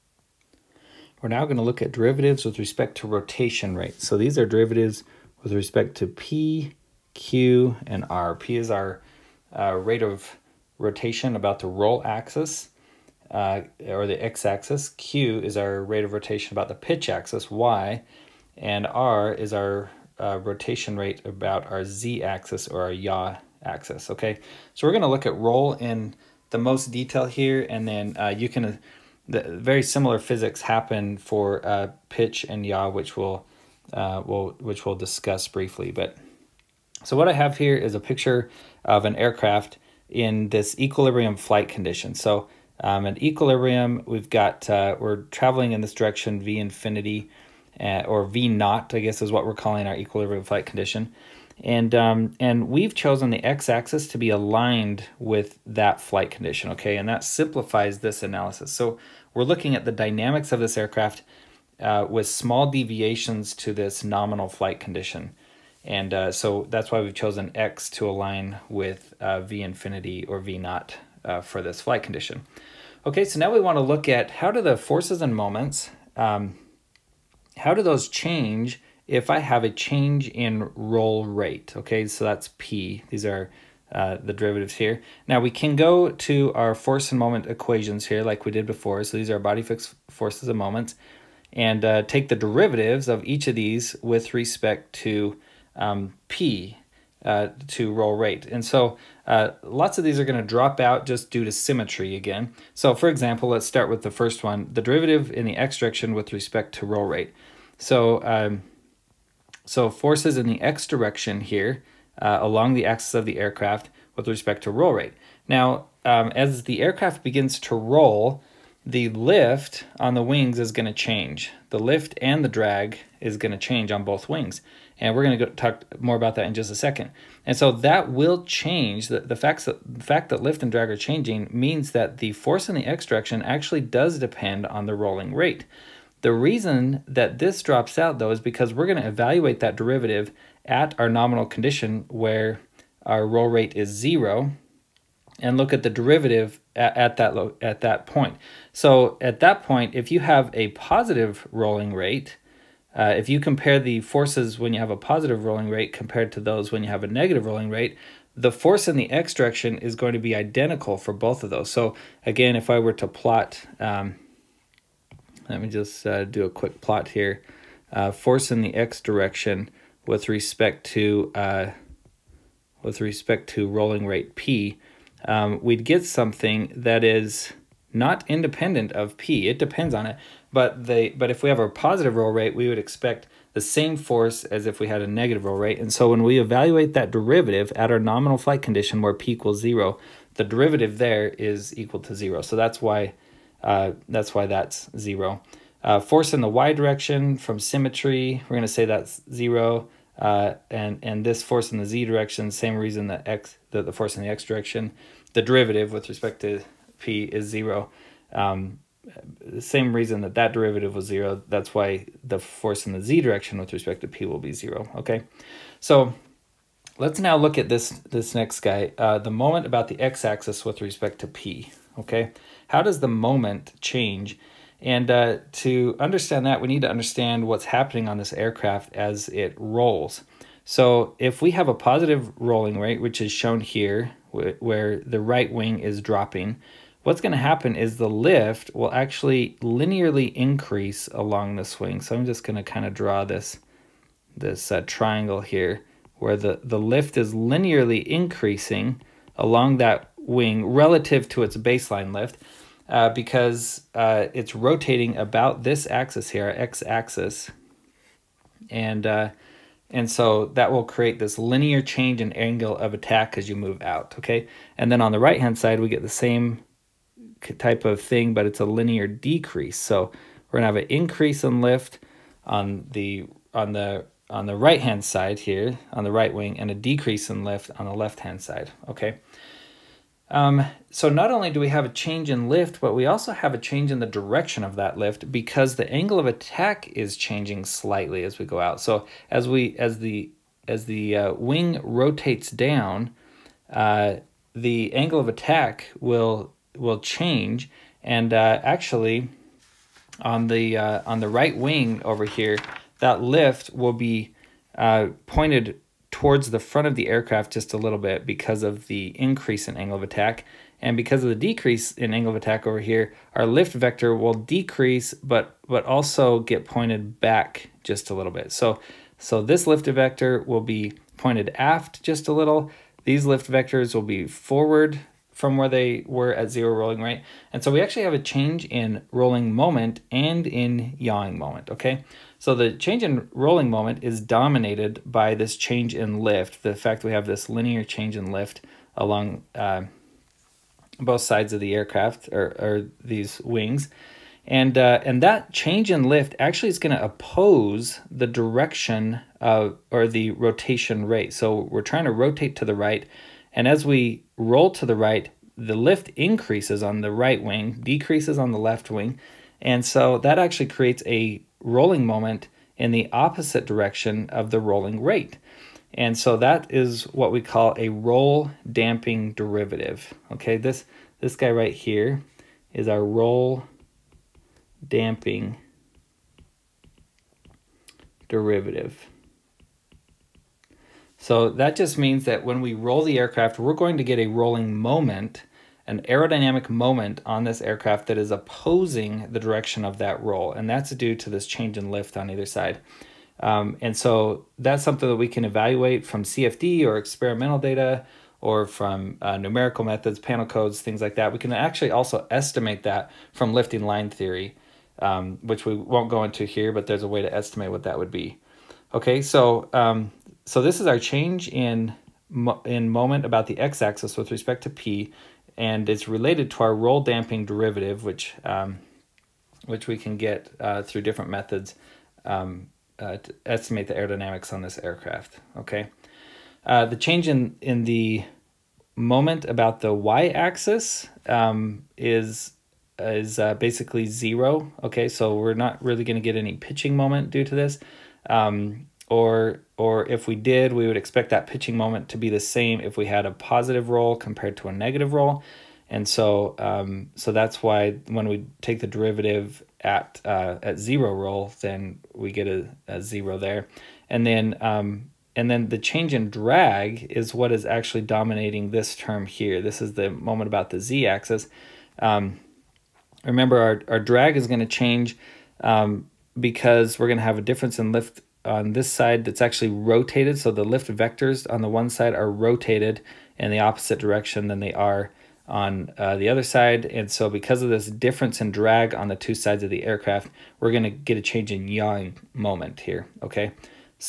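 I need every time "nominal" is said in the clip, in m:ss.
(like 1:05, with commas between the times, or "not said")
1:04, 2:21, 3:07.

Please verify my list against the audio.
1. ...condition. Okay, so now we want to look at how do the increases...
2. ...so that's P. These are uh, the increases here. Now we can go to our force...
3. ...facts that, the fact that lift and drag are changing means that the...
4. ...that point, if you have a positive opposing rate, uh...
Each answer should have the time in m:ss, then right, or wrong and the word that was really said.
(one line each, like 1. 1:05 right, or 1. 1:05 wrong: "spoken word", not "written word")
1. 1:12 wrong: "forces", not "increases"
2. 1:22 wrong: "derivatives", not "increases"
3. 2:09 right
4. 2:29 wrong: "rolling", not "opposing".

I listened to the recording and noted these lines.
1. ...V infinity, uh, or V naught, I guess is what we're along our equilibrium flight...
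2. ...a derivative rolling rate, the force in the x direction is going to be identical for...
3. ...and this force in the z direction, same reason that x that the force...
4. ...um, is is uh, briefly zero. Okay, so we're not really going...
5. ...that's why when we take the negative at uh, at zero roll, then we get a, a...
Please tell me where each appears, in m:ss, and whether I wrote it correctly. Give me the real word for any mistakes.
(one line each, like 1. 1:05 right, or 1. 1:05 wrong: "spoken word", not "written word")
1. 0:46 wrong: "calling", not "along"
2. 2:37 wrong: "negative", not "derivative"
3. 3:21 right
4. 7:11 wrong: "basically", not "briefly"
5. 7:27 wrong: "derivative", not "negative".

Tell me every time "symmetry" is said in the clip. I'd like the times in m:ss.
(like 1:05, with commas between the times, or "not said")
1:41, 3:17.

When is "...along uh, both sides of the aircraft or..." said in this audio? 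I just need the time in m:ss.
5:38.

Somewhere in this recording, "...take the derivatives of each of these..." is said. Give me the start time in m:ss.
1:32.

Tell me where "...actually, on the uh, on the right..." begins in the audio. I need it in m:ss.
4:58.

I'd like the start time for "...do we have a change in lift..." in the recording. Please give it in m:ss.
4:41.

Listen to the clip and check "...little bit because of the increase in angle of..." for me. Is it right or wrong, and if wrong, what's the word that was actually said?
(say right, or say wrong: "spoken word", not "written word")
right.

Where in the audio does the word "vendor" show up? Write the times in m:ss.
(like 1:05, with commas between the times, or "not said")
not said.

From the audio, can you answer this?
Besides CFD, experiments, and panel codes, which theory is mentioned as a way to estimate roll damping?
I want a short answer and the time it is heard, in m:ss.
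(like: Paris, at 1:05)
lifting line theory, at 6:43.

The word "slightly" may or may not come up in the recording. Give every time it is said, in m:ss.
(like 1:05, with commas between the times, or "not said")
4:47.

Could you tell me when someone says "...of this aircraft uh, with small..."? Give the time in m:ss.
1:00.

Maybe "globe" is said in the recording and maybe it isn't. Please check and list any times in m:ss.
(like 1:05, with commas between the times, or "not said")
not said.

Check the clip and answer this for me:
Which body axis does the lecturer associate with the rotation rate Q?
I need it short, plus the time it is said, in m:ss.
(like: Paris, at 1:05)
pitch axis, Y, at 0:16.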